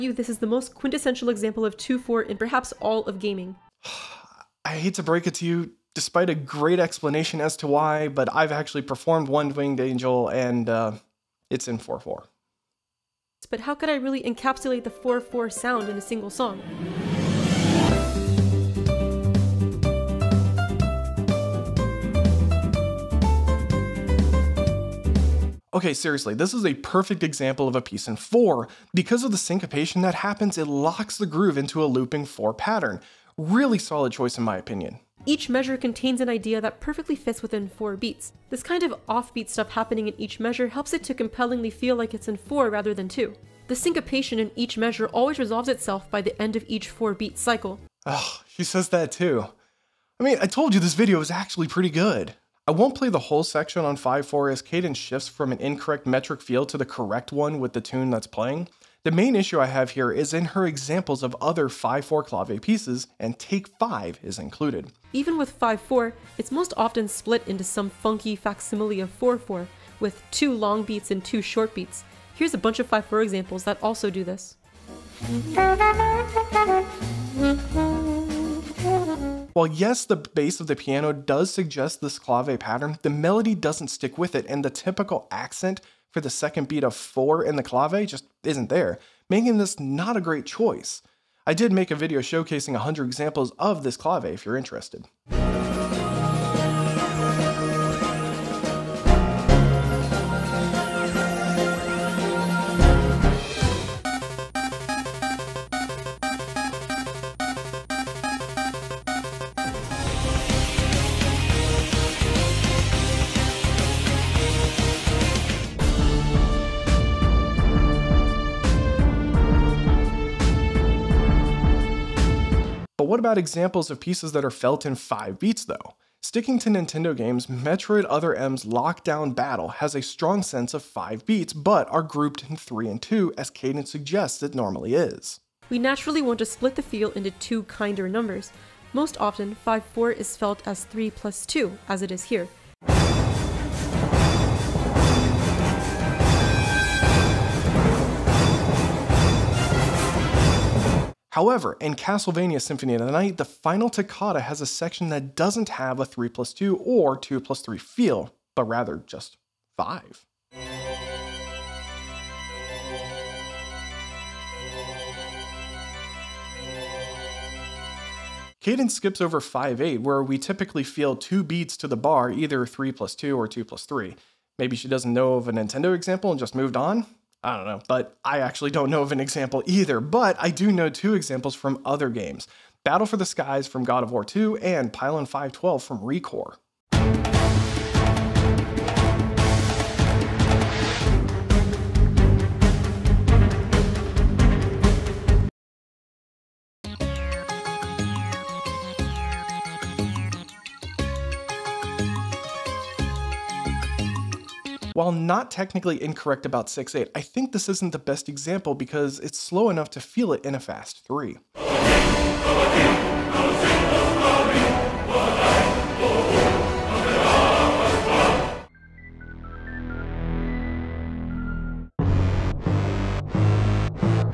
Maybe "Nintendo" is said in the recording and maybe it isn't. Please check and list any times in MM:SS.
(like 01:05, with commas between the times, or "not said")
02:06, 02:55.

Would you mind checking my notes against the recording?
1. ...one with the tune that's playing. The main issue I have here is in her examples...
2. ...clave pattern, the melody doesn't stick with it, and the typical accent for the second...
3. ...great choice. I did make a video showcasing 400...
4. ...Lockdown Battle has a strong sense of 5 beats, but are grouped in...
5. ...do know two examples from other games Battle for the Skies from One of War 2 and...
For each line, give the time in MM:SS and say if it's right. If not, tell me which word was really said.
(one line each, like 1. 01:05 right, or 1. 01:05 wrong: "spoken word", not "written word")
1. 00:57 right
2. 01:22 right
3. 01:30 wrong: "100", not "400"
4. 02:08 right
5. 03:00 wrong: "God", not "One".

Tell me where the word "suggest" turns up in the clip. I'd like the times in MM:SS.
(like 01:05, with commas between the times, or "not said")
01:21, 02:13.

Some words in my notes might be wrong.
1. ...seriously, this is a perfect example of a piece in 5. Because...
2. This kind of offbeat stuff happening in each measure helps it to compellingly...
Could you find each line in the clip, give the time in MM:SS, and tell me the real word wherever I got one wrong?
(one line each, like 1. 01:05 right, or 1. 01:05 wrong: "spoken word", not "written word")
1. 00:25 wrong: "4", not "5"
2. 00:38 right.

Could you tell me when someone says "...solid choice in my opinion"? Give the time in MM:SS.
00:33.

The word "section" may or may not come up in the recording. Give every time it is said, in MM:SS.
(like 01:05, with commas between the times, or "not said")
00:53, 02:34.